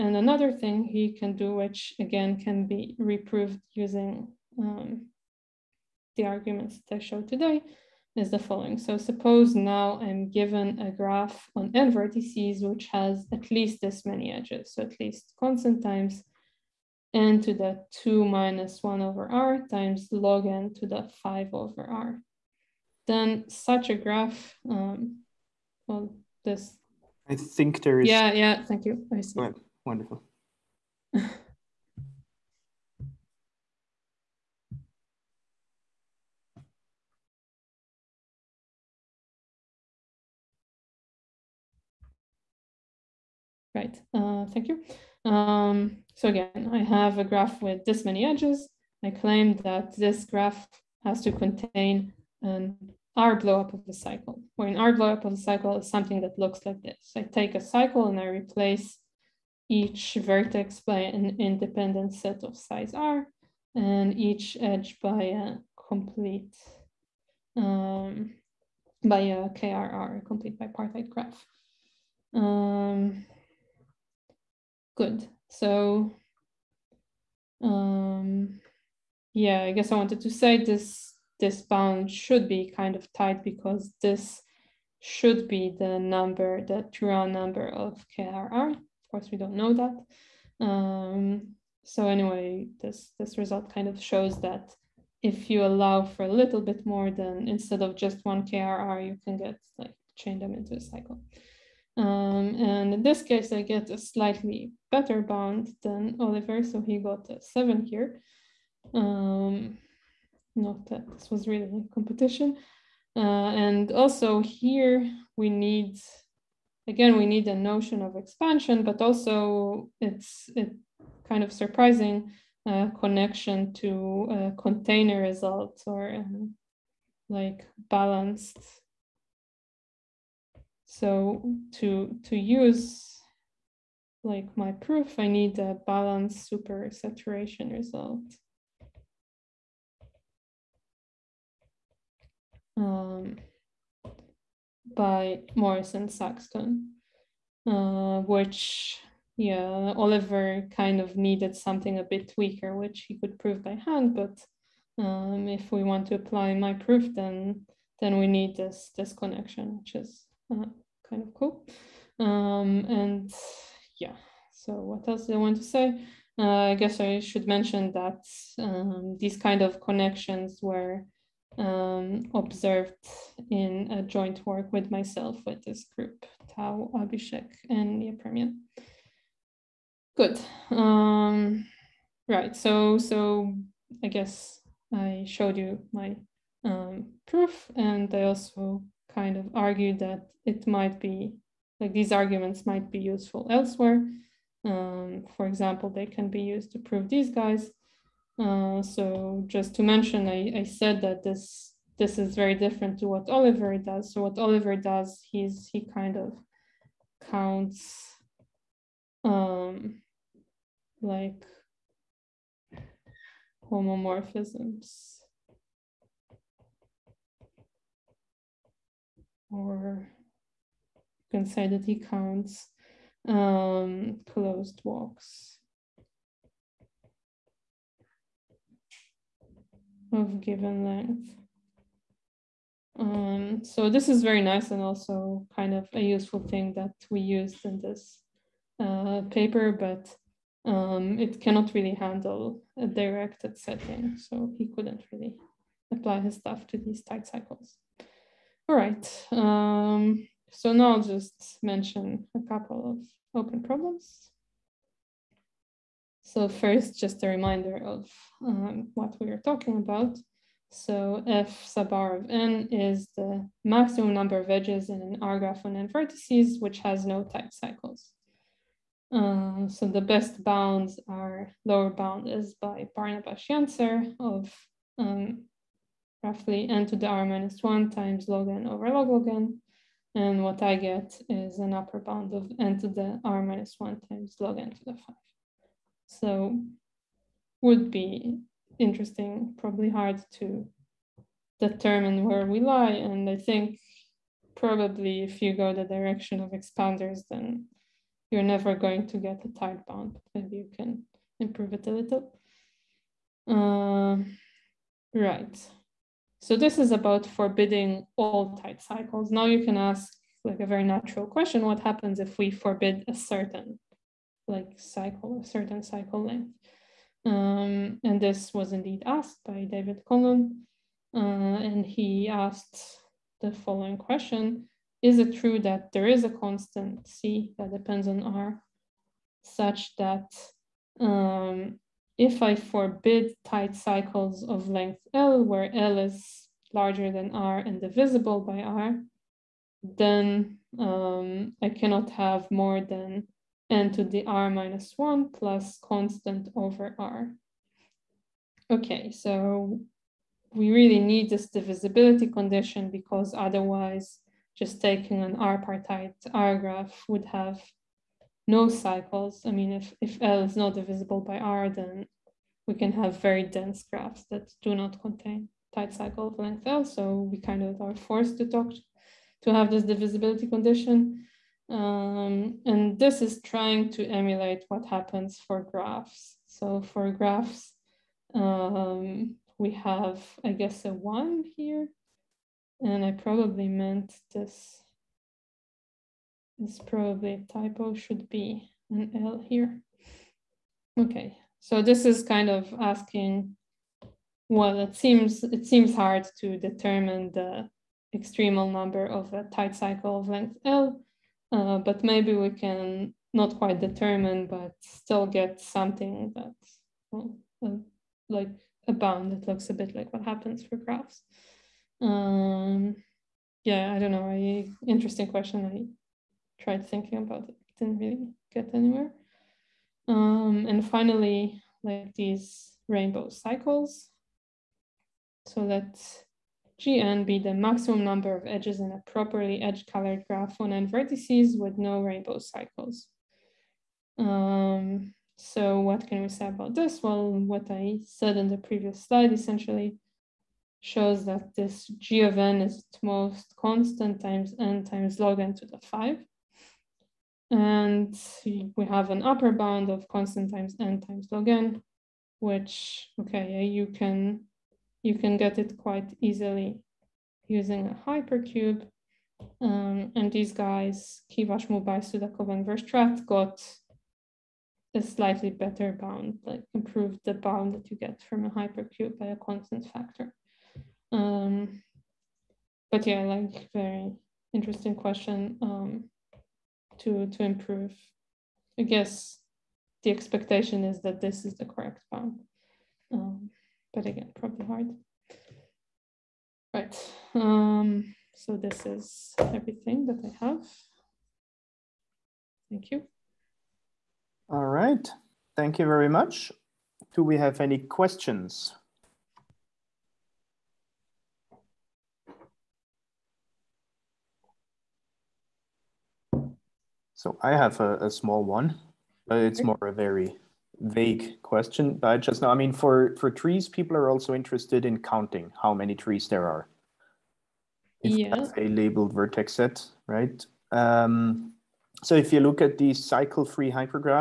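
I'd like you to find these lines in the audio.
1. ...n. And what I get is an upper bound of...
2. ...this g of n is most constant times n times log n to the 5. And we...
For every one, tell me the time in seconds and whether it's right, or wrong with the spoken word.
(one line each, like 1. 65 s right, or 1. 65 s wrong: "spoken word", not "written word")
1. 279 s right
2. 441 s right.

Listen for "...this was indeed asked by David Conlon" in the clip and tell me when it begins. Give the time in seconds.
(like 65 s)
318 s.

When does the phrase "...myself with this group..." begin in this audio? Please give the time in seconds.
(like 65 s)
174 s.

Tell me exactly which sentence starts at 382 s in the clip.
And I probably meant this it's probably typo, should be an L here.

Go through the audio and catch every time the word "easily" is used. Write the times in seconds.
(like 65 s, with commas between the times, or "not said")
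456 s.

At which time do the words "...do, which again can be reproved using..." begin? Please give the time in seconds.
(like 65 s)
1 s.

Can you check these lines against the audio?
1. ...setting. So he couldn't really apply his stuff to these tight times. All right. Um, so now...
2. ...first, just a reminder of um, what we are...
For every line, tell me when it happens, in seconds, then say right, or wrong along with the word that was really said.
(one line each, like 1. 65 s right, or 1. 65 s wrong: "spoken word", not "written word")
1. 243 s wrong: "cycles", not "times"
2. 256 s right.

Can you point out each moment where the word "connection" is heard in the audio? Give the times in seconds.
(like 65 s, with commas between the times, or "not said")
122 s, 159 s, 169 s.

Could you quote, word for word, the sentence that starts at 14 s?
So at least constant times n to the 2 minus 1 over r times log n to the 5 over r.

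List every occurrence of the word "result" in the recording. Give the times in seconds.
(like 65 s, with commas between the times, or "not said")
93 s, 125 s, 137 s.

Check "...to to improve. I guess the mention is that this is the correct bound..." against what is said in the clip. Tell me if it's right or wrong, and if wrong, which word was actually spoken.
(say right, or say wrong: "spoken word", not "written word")
wrong: "expectation", not "mention".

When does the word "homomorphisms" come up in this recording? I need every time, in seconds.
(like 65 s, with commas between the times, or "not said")
213 s.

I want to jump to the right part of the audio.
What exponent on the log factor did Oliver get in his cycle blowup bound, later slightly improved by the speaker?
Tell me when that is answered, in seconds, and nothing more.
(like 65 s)
107 s.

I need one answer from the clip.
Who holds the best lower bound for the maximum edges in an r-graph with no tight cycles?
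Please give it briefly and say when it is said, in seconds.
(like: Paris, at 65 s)
Barnabás Janzer, at 272 s.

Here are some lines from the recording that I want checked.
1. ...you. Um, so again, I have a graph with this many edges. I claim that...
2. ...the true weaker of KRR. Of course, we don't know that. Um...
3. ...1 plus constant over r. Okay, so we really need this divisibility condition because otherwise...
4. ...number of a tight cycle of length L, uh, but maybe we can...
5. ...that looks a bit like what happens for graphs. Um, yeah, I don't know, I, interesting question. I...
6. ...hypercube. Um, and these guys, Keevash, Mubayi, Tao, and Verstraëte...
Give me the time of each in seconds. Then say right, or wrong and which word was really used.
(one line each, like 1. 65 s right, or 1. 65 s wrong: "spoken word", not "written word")
1. 44 s right
2. 86 s wrong: "number", not "weaker"
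3. 344 s right
4. 398 s right
5. 409 s right
6. 458 s wrong: "Sudakov", not "Tao".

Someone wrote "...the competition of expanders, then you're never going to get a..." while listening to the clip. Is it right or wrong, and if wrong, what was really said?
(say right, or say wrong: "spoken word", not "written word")
wrong: "direction", not "competition".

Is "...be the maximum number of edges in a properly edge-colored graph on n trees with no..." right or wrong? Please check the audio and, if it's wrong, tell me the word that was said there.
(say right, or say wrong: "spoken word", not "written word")
wrong: "vertices", not "trees".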